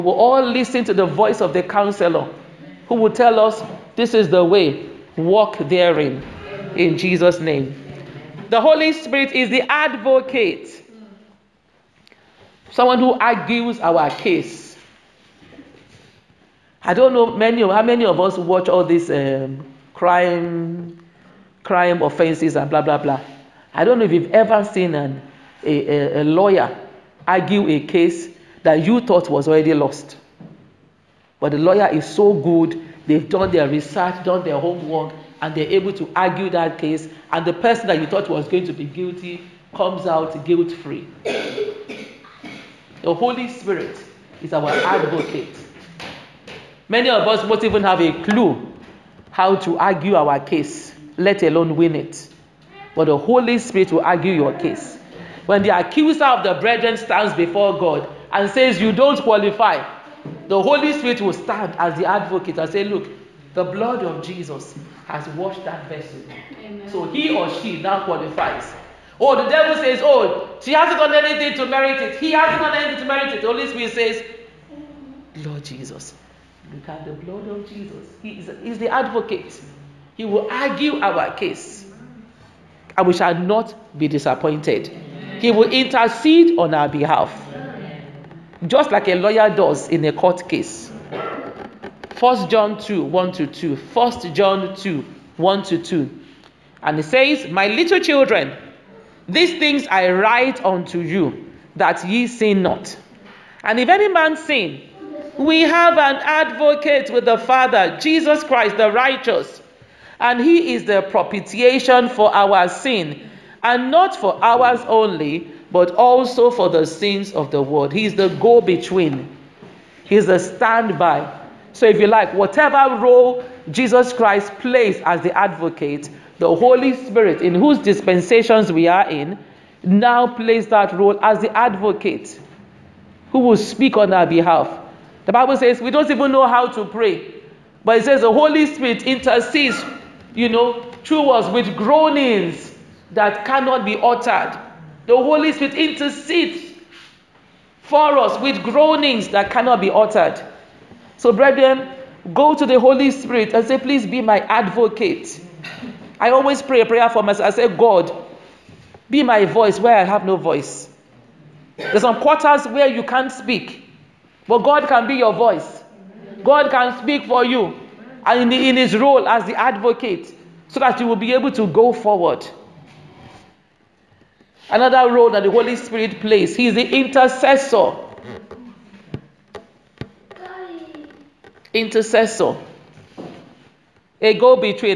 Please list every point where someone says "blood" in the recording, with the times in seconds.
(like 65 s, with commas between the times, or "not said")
63 s, 77 s.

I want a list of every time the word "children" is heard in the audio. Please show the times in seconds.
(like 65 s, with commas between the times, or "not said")
97 s.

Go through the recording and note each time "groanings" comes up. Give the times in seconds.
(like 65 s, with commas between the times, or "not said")
141 s, 148 s.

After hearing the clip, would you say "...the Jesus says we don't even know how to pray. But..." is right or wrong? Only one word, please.
wrong.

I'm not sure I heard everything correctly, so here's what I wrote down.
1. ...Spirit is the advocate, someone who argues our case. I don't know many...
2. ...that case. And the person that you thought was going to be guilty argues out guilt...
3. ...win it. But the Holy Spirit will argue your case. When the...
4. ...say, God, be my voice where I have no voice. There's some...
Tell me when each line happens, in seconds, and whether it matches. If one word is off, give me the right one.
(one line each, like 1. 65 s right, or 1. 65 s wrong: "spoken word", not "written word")
1. 8 s right
2. 36 s wrong: "comes", not "argues"
3. 51 s right
4. 157 s right.